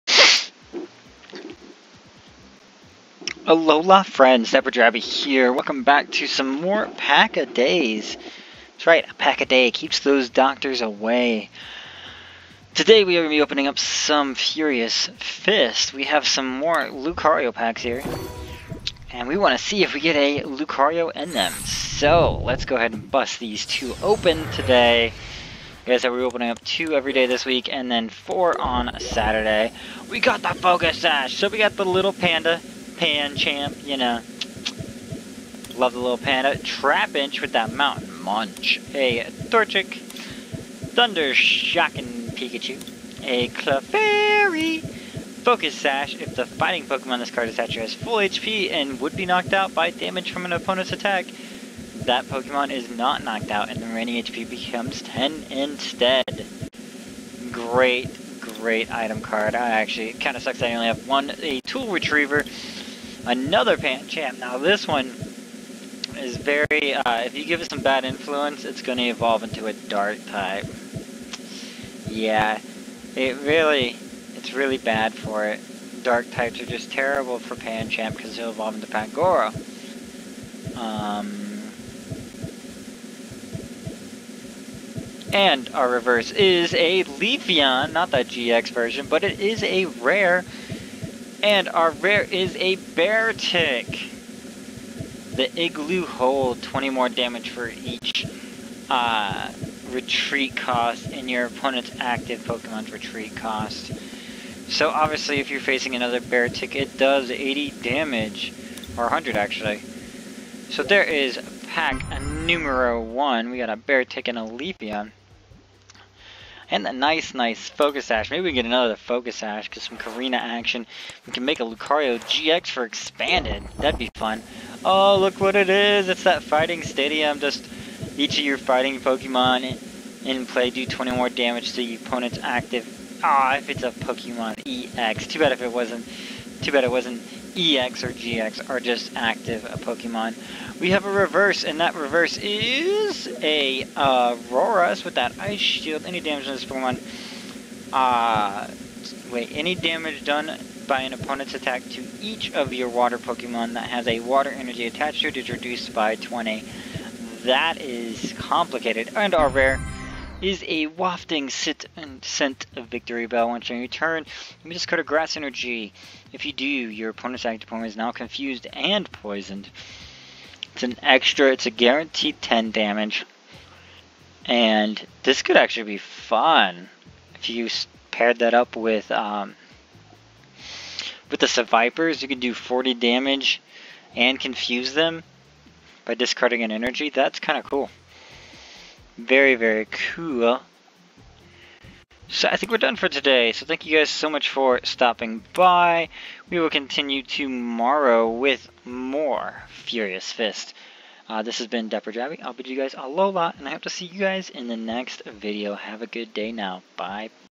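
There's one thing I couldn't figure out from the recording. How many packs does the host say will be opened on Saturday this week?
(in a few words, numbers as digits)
4.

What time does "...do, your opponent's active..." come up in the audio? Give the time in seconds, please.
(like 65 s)
166 s.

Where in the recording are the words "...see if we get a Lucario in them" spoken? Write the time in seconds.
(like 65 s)
19 s.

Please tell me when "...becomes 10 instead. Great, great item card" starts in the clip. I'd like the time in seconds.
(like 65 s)
54 s.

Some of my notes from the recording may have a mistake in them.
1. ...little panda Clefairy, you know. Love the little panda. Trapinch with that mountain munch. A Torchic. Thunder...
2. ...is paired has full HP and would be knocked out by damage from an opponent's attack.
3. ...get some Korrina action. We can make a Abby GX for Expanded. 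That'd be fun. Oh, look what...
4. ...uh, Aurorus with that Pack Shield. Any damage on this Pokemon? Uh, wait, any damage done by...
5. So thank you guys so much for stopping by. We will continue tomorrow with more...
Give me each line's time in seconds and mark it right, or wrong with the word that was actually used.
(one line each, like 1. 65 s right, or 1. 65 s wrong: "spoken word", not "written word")
1. 31 s wrong: "Pancham", not "Clefairy"
2. 47 s wrong: "attached", not "paired"
3. 119 s wrong: "Lucario", not "Abby"
4. 143 s wrong: "Ice", not "Pack"
5. 193 s right.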